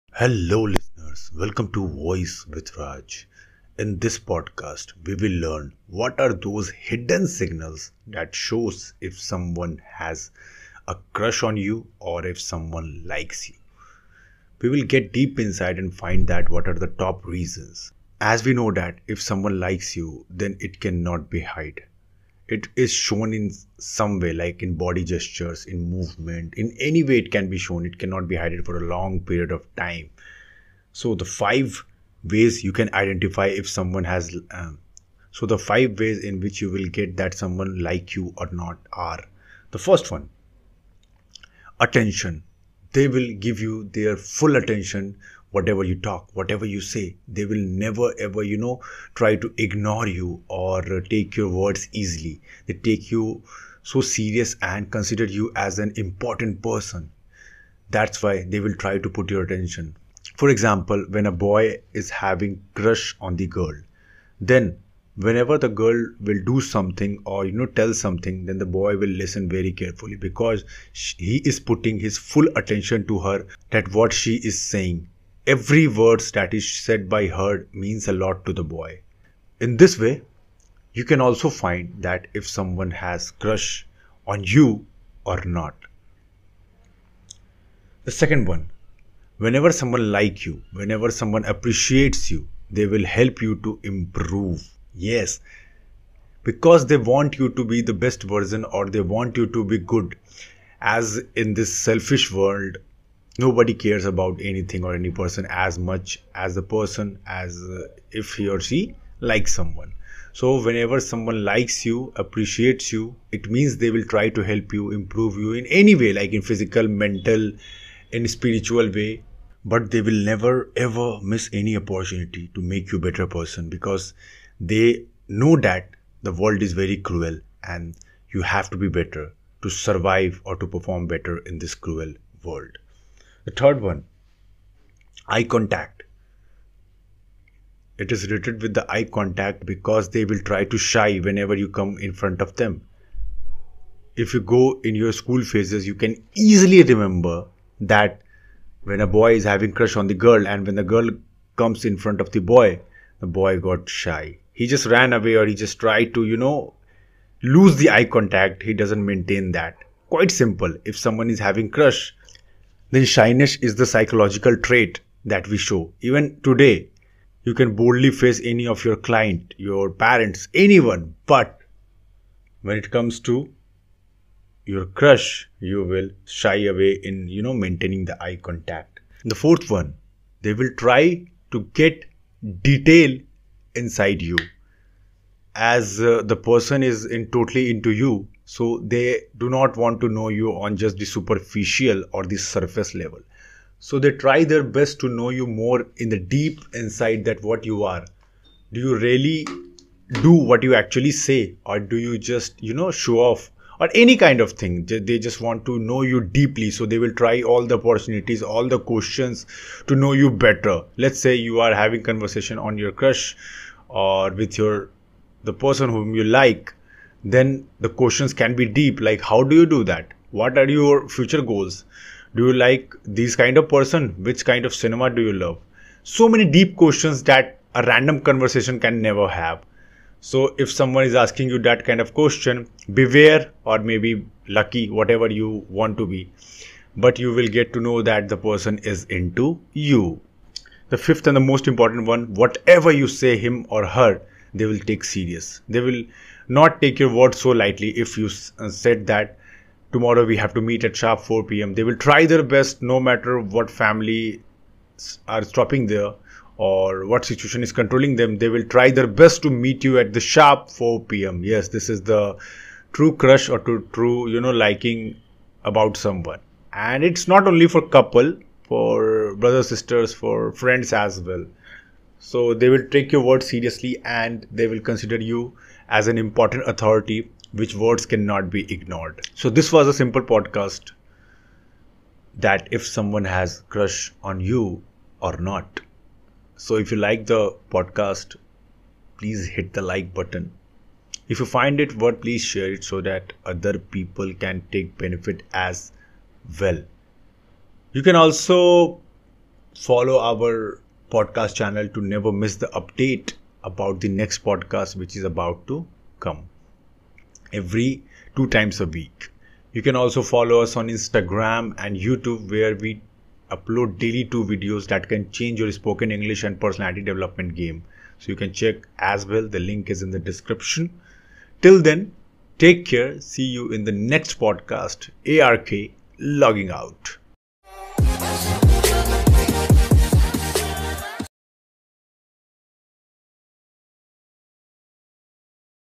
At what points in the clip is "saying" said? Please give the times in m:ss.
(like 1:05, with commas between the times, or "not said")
1:14.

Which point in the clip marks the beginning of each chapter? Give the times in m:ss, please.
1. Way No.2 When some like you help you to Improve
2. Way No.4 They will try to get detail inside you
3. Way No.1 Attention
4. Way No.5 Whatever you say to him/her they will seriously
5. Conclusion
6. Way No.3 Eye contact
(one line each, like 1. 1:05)
1. 1:27
2. 2:59
3. 0:39
4. 4:00
5. 4:39
6. 2:13.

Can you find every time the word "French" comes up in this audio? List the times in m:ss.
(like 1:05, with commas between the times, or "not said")
not said.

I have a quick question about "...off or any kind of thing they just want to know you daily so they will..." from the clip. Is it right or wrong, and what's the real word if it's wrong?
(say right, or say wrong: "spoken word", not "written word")
wrong: "deeply", not "daily".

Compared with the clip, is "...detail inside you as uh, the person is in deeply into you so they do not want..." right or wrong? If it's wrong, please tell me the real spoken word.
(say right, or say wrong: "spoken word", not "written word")
wrong: "totally", not "deeply".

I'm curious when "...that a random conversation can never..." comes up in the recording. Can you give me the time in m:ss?
3:47.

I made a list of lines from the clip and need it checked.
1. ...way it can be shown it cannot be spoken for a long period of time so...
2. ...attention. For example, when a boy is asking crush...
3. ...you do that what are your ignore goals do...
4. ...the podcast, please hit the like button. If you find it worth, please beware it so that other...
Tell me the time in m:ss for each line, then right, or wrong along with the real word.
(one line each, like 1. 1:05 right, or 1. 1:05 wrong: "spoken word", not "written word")
1. 0:27 wrong: "hidden", not "spoken"
2. 0:59 wrong: "having", not "asking"
3. 3:39 wrong: "future", not "ignore"
4. 4:47 wrong: "share", not "beware".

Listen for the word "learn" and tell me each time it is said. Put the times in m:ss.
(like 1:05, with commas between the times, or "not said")
0:05.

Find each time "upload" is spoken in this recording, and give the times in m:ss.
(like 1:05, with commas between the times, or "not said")
5:13.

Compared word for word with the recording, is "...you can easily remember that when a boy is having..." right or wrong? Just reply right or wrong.
right.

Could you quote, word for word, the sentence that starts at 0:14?
We will get deep inside and find that what are the top reasons.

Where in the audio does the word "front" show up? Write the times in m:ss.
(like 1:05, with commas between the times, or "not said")
2:22, 2:31.